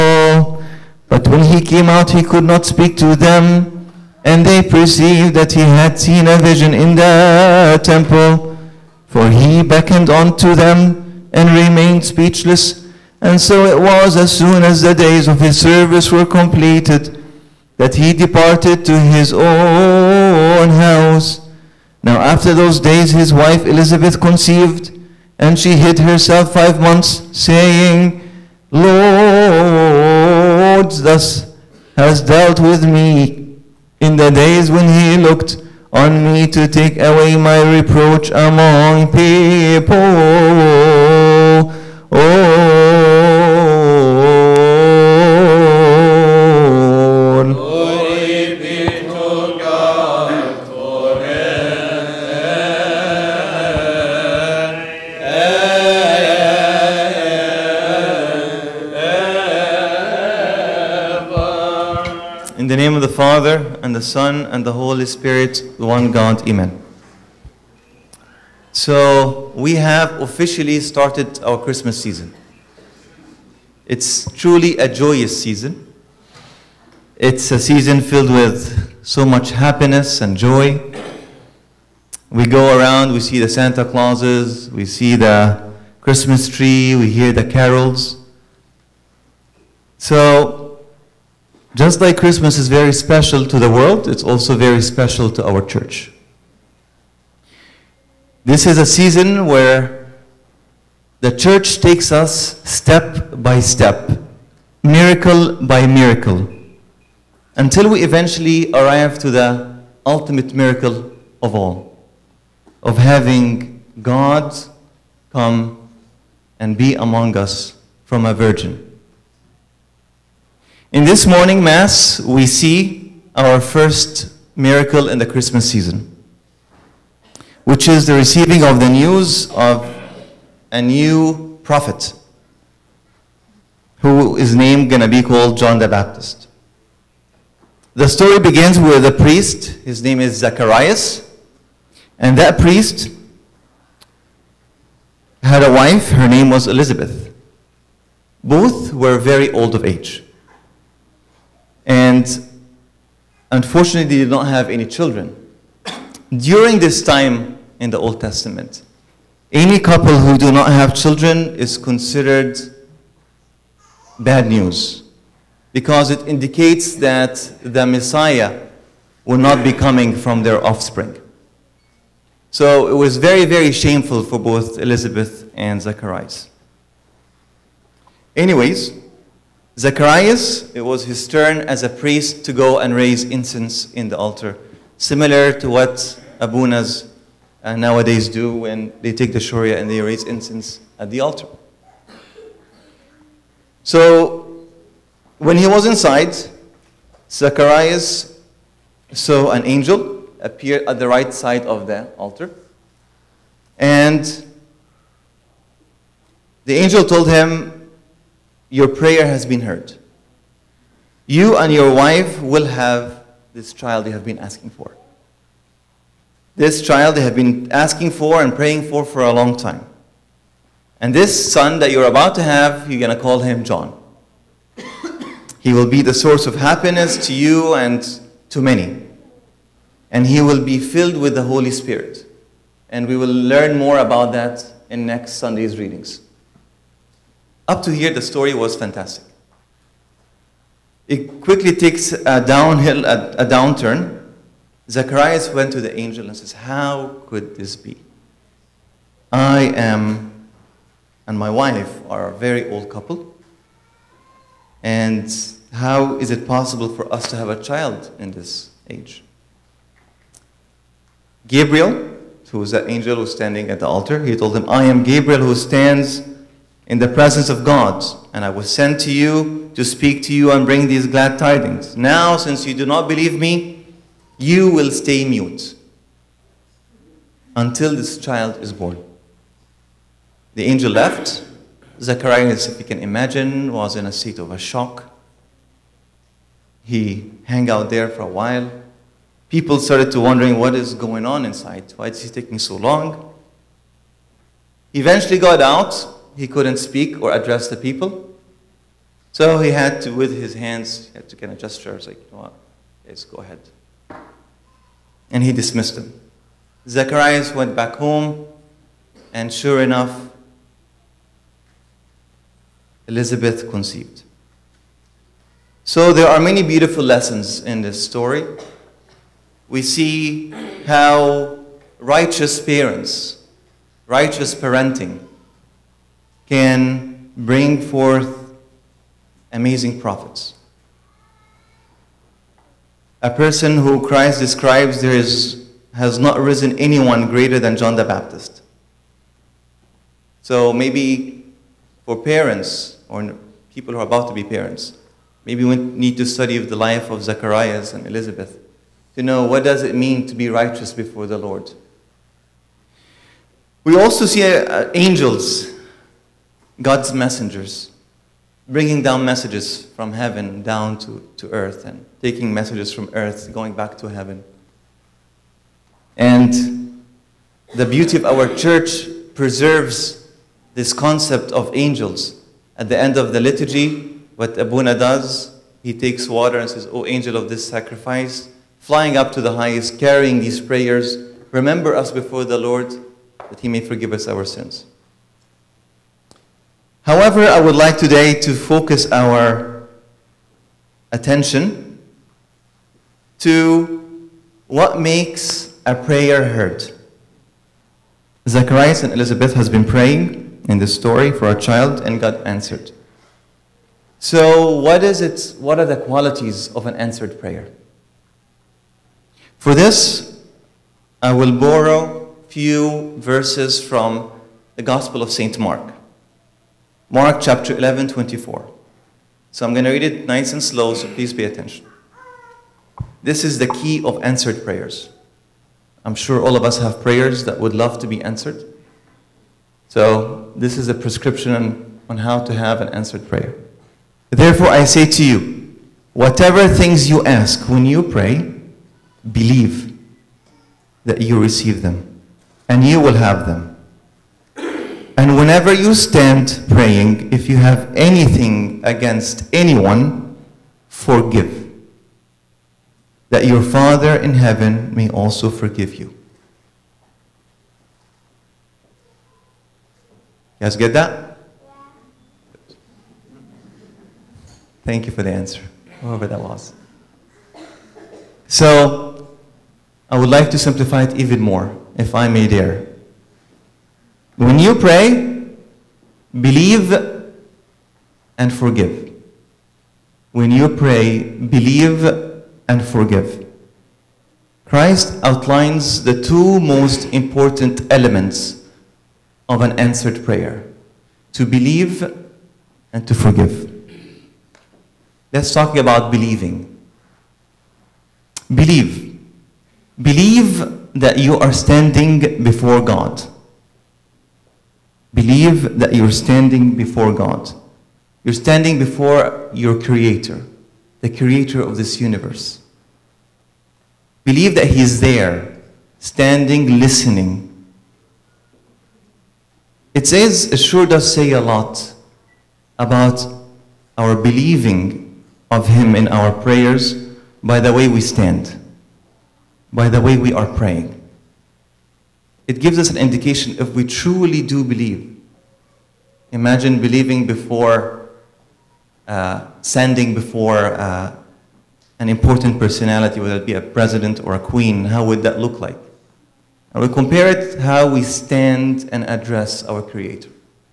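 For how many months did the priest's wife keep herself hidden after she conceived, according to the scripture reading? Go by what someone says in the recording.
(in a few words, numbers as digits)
5.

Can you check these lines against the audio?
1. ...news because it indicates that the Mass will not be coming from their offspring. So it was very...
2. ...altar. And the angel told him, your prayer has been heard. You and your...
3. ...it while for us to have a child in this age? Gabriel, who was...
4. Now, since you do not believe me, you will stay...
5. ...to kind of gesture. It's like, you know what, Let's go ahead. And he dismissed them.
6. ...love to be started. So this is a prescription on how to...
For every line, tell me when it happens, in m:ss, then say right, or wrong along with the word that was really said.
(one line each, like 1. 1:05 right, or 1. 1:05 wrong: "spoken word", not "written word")
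1. 2:44 wrong: "Messiah", not "Mass"
2. 3:22 right
3. 4:16 wrong: "possible", not "while"
4. 4:31 right
5. 5:01 right
6. 7:07 wrong: "answered", not "started".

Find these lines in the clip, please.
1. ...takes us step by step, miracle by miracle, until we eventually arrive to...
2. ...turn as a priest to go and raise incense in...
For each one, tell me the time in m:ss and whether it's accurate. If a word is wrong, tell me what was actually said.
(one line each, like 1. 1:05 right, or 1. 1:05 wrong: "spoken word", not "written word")
1. 1:41 right
2. 3:01 right.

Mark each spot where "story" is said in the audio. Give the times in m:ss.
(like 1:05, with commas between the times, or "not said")
2:18, 3:58, 5:18, 6:40.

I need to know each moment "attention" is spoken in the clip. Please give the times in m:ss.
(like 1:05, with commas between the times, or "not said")
6:31, 7:01.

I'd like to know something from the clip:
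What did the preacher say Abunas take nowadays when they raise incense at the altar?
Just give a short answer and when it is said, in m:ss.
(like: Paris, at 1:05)
shorya, at 3:09.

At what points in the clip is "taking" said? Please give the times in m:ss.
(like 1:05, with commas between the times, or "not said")
4:52, 6:02.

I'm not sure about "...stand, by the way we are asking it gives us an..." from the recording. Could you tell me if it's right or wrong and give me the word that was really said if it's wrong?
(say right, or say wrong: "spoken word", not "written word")
wrong: "praying", not "asking".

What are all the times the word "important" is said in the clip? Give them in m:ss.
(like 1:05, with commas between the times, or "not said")
8:07, 9:02.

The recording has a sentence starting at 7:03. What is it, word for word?
This is the key of answered prayers.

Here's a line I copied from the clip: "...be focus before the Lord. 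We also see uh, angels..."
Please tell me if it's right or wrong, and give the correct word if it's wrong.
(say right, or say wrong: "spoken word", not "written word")
wrong: "righteous", not "focus".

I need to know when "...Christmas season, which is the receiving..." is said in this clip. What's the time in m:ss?
2:05.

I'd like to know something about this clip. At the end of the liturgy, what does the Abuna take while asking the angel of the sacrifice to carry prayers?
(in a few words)
water.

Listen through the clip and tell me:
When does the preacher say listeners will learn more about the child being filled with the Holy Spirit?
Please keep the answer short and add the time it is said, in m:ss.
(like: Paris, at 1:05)
next Sunday, at 3:55.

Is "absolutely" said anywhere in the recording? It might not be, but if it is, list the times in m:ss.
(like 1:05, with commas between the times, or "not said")
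not said.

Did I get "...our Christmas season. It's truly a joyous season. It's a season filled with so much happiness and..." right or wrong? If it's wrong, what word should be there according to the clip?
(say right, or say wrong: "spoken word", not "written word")
right.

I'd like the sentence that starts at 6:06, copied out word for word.
And the beauty of our church preserves this concept of angels.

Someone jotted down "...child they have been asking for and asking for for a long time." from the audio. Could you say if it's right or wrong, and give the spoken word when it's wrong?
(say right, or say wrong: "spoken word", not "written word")
wrong: "praying", not "asking".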